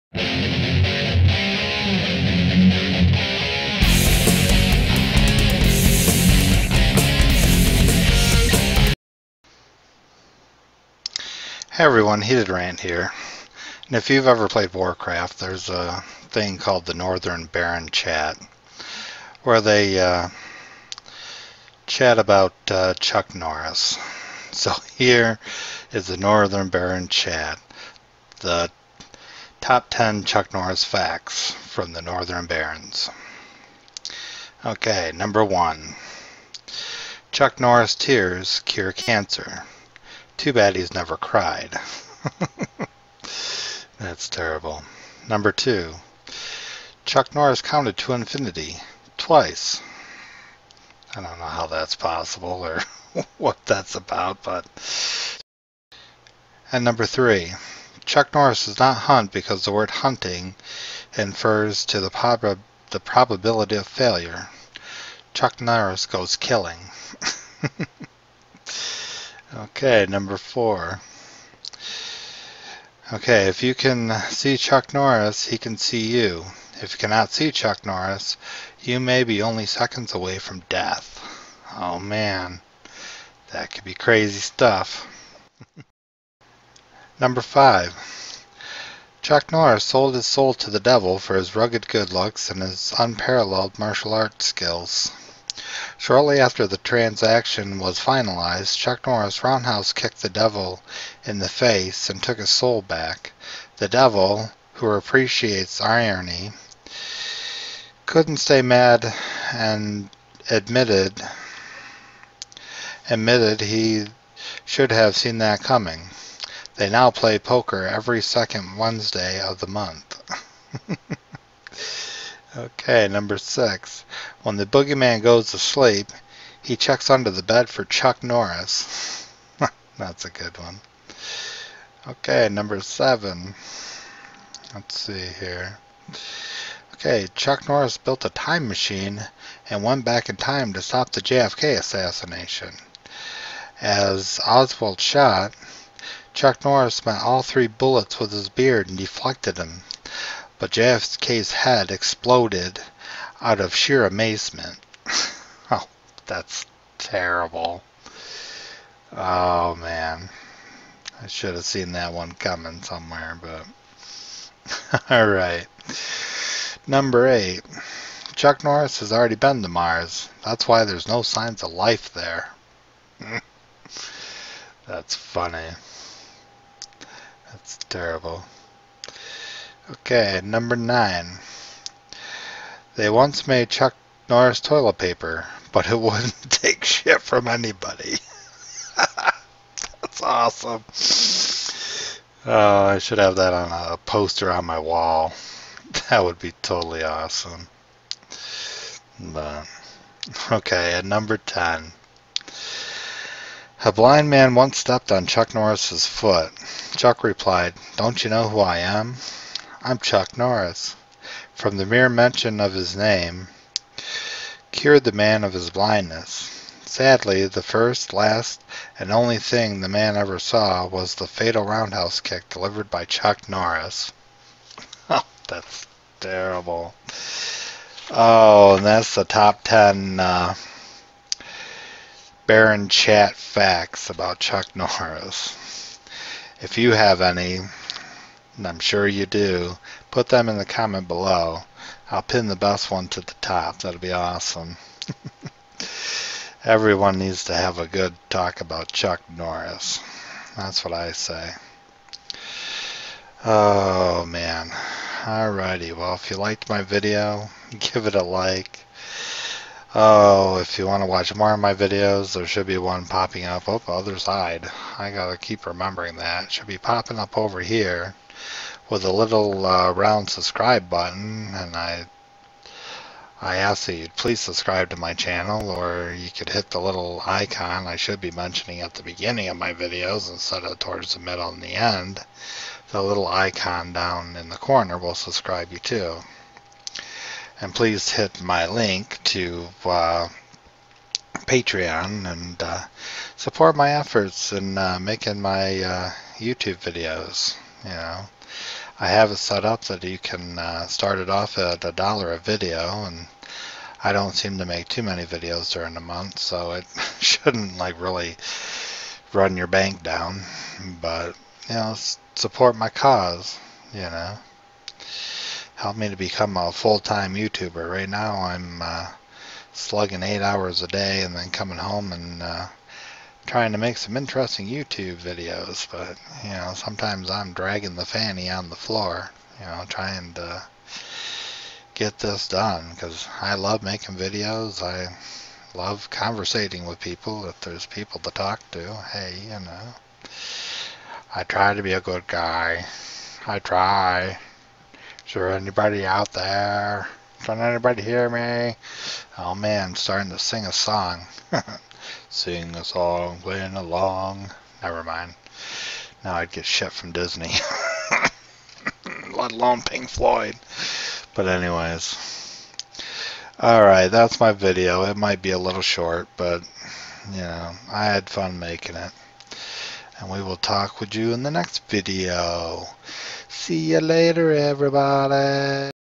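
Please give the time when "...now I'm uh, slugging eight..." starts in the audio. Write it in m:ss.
5:18.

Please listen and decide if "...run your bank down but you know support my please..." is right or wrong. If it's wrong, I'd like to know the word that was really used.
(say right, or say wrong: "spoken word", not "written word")
wrong: "cause", not "please".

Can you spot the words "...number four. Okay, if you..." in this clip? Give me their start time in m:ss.
1:10.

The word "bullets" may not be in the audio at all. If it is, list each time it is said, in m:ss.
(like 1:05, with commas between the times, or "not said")
2:27.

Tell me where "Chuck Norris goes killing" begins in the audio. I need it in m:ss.
1:05.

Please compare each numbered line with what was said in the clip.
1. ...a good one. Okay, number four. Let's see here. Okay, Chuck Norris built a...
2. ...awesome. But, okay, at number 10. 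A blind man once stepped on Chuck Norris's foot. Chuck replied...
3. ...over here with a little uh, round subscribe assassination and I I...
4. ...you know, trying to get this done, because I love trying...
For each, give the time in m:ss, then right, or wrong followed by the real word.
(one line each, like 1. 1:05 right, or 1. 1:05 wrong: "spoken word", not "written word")
1. 2:10 wrong: "seven", not "four"
2. 3:17 right
3. 4:27 wrong: "button", not "assassination"
4. 5:29 wrong: "making", not "trying".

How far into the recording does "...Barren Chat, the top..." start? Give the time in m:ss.
0:26.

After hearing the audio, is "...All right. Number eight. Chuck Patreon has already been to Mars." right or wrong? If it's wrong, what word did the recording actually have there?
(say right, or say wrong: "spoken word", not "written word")
wrong: "Norris", not "Patreon".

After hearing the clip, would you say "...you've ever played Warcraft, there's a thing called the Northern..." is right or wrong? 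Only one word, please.
right.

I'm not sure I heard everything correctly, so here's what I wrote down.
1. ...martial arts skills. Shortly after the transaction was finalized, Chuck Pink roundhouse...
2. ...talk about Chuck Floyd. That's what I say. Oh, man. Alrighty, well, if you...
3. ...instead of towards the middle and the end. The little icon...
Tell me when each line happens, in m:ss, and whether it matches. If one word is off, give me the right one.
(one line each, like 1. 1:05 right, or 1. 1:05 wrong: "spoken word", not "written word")
1. 1:33 wrong: "Norris", not "Pink"
2. 4:08 wrong: "Norris", not "Floyd"
3. 4:40 right.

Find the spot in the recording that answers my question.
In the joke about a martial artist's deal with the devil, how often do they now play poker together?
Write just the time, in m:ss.
1:57.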